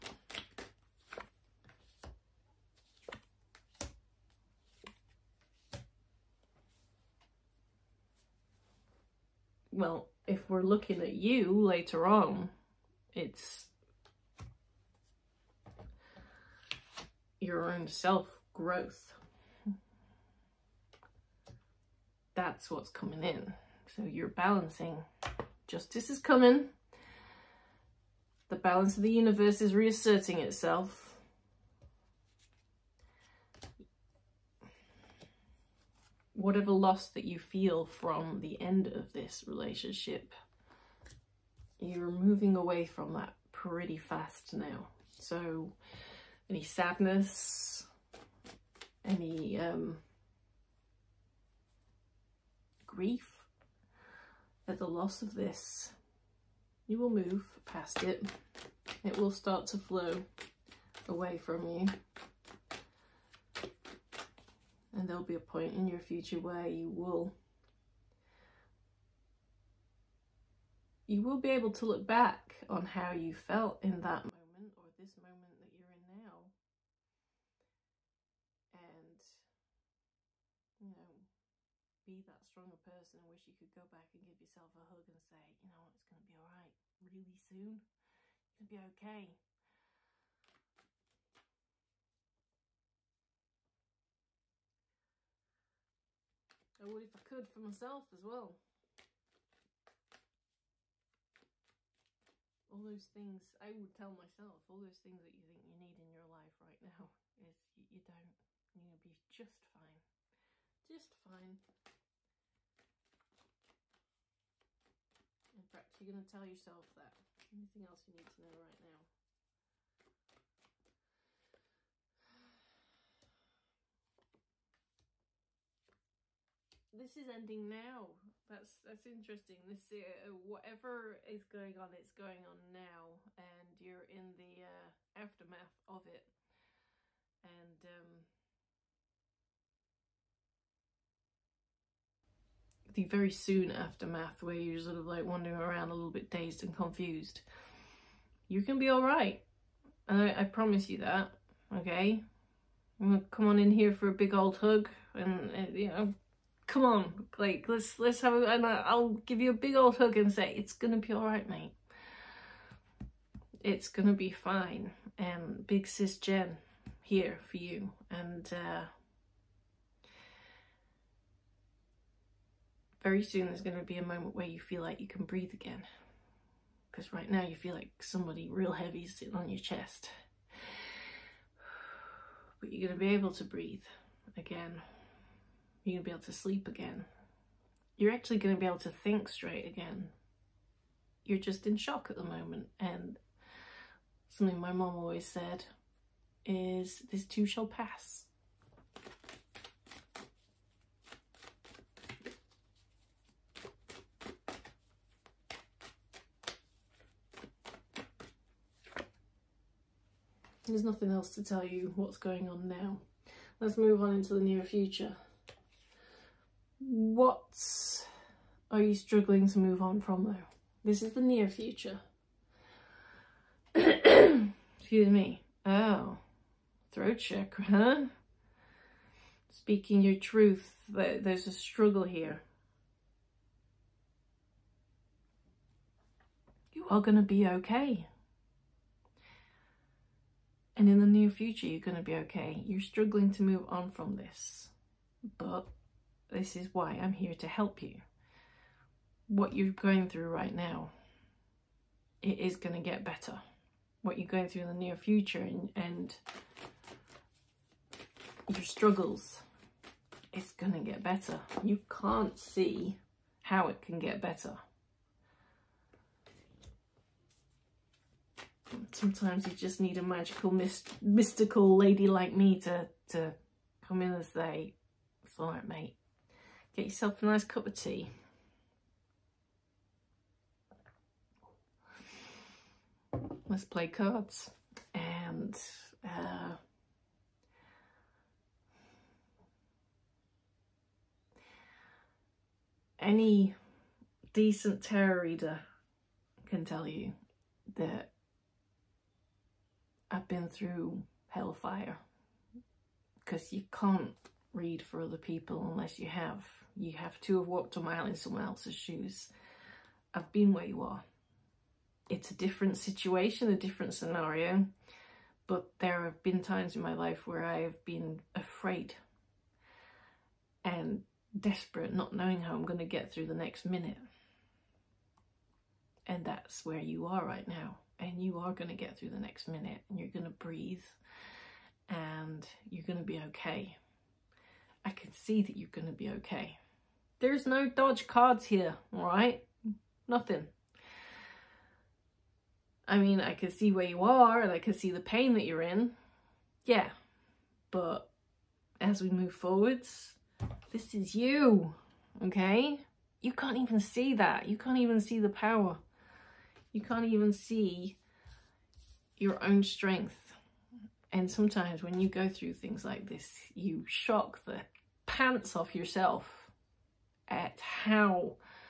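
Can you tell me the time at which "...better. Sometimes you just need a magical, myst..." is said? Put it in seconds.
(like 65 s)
264 s.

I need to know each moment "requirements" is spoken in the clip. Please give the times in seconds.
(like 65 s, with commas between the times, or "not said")
not said.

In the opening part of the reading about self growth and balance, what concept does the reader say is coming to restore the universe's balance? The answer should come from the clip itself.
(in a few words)
Justice.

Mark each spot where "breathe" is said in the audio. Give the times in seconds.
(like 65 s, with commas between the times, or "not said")
175 s, 183 s, 330 s.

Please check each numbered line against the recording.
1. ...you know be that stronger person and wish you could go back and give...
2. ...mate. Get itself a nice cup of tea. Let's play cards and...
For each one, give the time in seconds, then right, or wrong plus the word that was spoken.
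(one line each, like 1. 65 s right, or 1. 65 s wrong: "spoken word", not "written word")
1. 80 s right
2. 275 s wrong: "yourself", not "itself".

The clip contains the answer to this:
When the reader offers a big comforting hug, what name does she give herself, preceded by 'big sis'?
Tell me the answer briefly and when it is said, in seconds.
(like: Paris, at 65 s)
Jen, at 166 s.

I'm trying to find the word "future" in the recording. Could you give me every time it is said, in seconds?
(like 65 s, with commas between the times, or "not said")
65 s, 214 s, 221 s, 241 s, 254 s.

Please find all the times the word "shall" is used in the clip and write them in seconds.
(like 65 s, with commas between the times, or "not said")
197 s.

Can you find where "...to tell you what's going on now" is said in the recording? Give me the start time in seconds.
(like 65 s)
211 s.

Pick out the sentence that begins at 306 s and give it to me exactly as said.
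You have to have walked a mile in someone else's shoes.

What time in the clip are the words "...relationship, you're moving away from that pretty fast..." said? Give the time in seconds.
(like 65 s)
39 s.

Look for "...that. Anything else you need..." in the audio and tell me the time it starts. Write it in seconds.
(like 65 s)
116 s.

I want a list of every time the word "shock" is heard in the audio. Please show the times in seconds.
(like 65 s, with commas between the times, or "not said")
191 s, 363 s.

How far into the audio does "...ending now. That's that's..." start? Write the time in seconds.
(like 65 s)
127 s.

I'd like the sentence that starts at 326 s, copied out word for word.
And that's where you are right now.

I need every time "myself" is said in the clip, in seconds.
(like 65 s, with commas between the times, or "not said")
97 s, 104 s.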